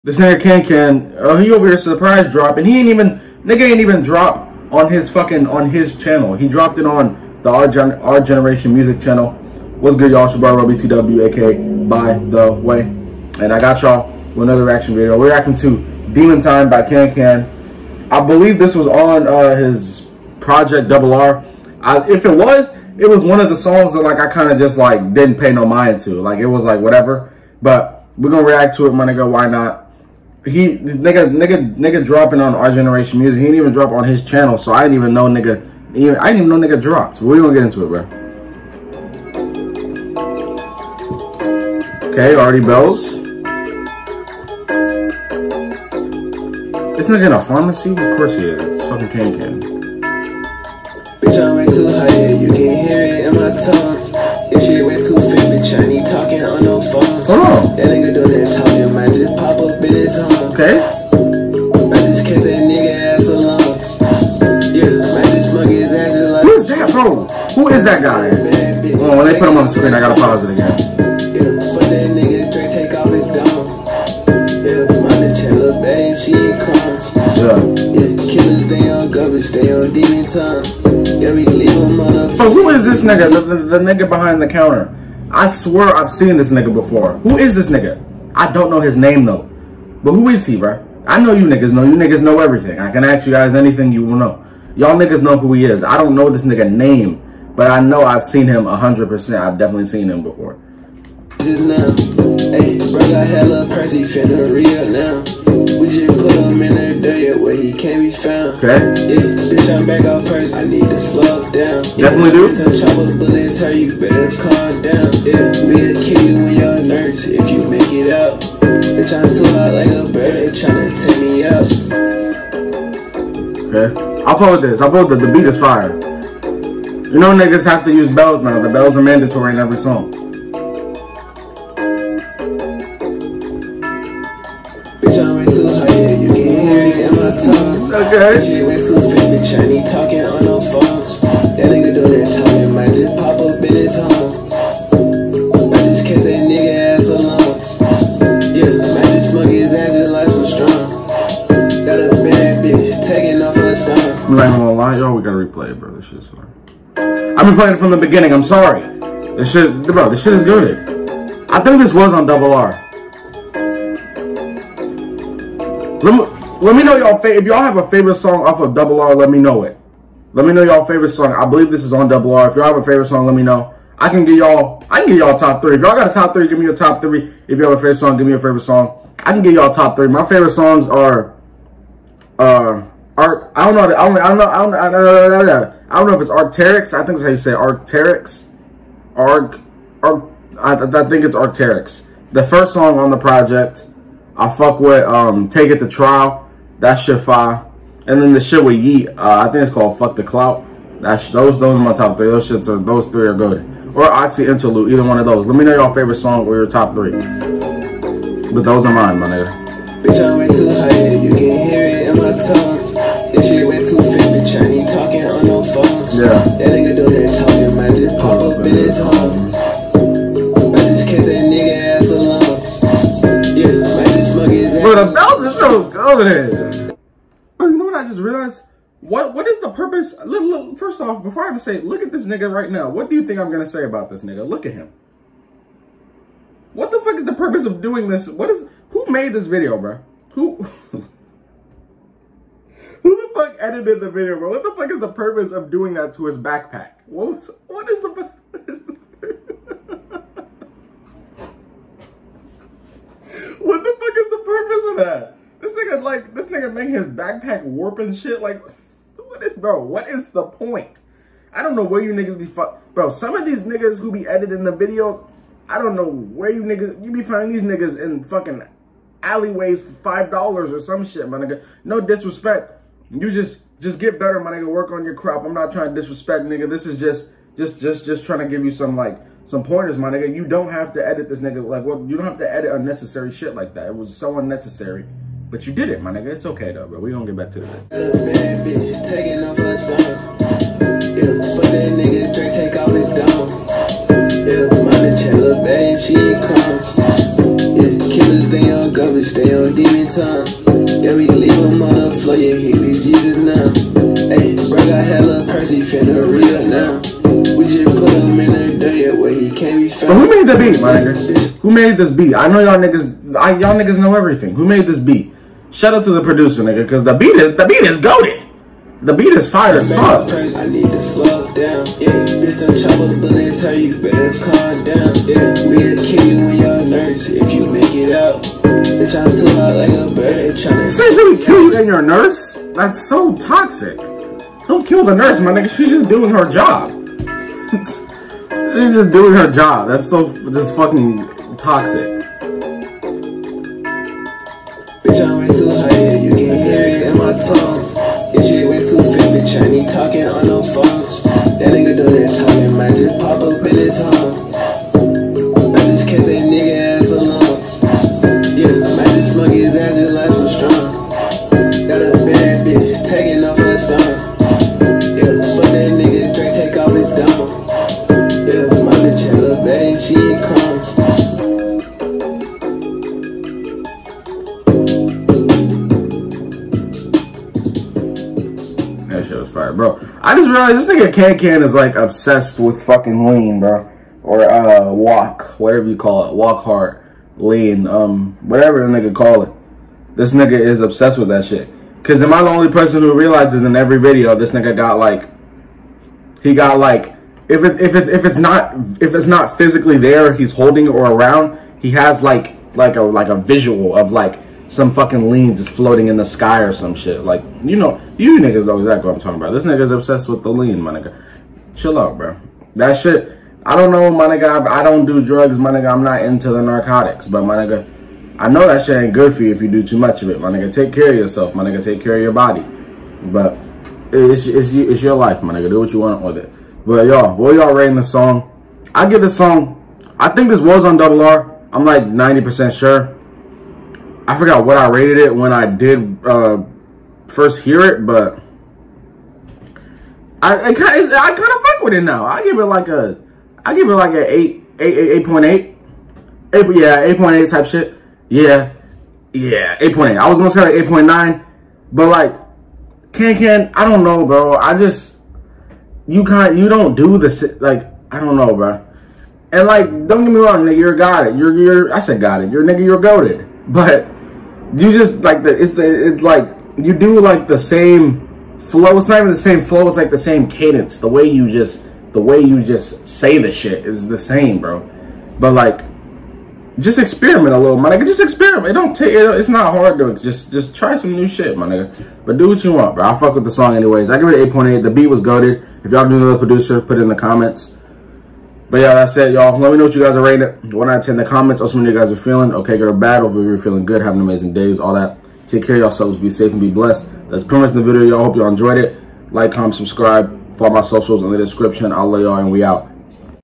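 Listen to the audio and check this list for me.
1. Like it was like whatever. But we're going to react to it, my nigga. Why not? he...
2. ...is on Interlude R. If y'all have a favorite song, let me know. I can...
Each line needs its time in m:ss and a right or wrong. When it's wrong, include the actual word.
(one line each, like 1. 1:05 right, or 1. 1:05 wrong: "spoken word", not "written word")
1. 0:26 right
2. 2:51 wrong: "Double", not "Interlude".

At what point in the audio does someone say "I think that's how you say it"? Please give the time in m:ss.
3:06.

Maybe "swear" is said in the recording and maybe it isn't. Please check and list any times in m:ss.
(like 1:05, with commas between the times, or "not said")
1:25.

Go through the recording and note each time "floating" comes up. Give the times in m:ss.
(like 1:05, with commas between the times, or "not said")
6:45.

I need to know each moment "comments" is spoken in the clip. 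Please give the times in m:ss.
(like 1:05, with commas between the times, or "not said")
8:07, 8:11, 8:19.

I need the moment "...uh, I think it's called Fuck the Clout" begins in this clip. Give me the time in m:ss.
3:19.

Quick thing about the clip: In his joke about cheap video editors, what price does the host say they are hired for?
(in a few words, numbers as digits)
$5.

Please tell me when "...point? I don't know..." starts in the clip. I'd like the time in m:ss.
4:20.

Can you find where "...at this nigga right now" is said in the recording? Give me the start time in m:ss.
3:52.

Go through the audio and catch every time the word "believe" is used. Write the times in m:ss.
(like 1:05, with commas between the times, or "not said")
0:18, 2:51.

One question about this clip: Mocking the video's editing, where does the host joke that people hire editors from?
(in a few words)
Alleyways.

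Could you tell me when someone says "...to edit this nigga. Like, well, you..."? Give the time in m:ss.
4:40.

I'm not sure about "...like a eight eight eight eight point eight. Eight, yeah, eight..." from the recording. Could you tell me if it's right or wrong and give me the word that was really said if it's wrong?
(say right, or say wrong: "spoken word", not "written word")
right.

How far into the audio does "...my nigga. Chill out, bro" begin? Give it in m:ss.
6:50.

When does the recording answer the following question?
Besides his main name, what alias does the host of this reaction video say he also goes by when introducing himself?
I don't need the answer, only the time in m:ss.
0:11.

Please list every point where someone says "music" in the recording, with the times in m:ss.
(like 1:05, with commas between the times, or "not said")
0:08, 0:33.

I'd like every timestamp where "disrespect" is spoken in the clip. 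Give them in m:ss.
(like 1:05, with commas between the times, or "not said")
4:32, 4:36.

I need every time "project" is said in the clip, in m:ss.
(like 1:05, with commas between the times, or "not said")
0:20, 3:13.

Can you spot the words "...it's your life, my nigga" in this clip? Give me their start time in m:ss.
7:04.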